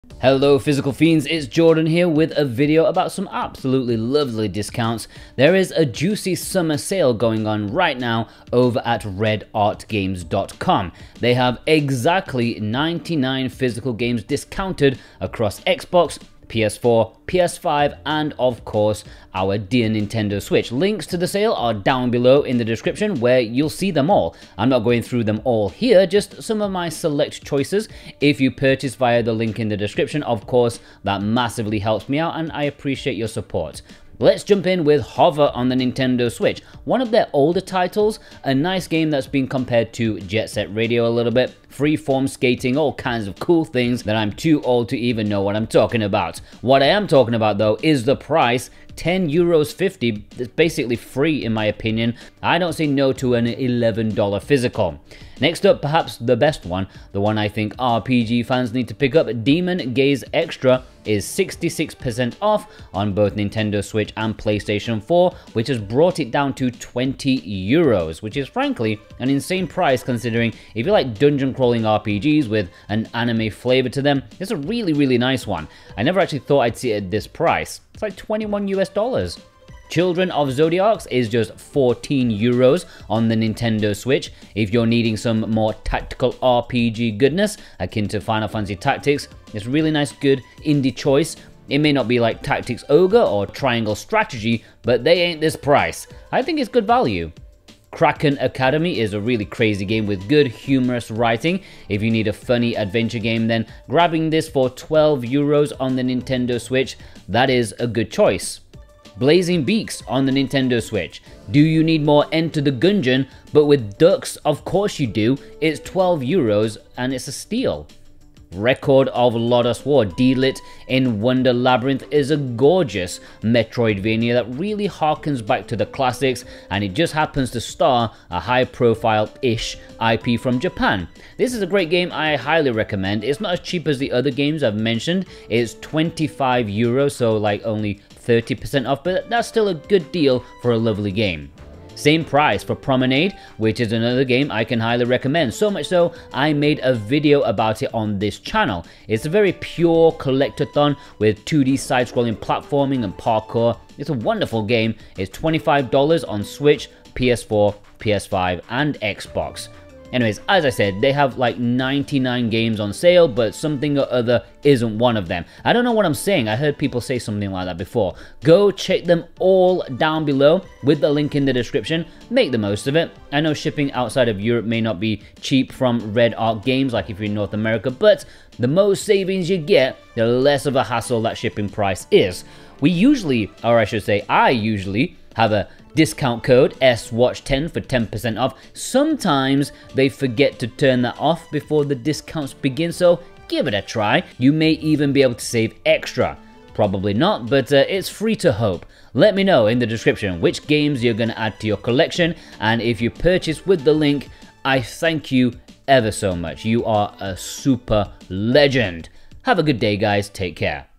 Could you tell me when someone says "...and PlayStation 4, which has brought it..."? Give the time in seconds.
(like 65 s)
64 s.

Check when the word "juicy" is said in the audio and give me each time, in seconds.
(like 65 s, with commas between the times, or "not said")
5 s.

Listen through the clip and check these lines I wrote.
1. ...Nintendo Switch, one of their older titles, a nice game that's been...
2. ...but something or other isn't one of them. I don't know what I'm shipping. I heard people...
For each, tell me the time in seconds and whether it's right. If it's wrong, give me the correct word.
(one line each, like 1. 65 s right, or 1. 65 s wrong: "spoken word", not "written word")
1. 35 s right
2. 163 s wrong: "saying", not "shipping".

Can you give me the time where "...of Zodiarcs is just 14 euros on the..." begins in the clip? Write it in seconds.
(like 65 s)
80 s.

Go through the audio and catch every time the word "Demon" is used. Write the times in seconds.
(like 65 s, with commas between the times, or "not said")
59 s.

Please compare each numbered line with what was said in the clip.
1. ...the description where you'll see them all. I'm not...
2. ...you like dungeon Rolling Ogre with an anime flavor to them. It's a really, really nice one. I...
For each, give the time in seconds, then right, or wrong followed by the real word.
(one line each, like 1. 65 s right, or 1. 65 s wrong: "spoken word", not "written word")
1. 22 s right
2. 70 s wrong: "RPGs", not "Ogre".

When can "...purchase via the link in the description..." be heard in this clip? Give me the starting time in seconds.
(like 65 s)
28 s.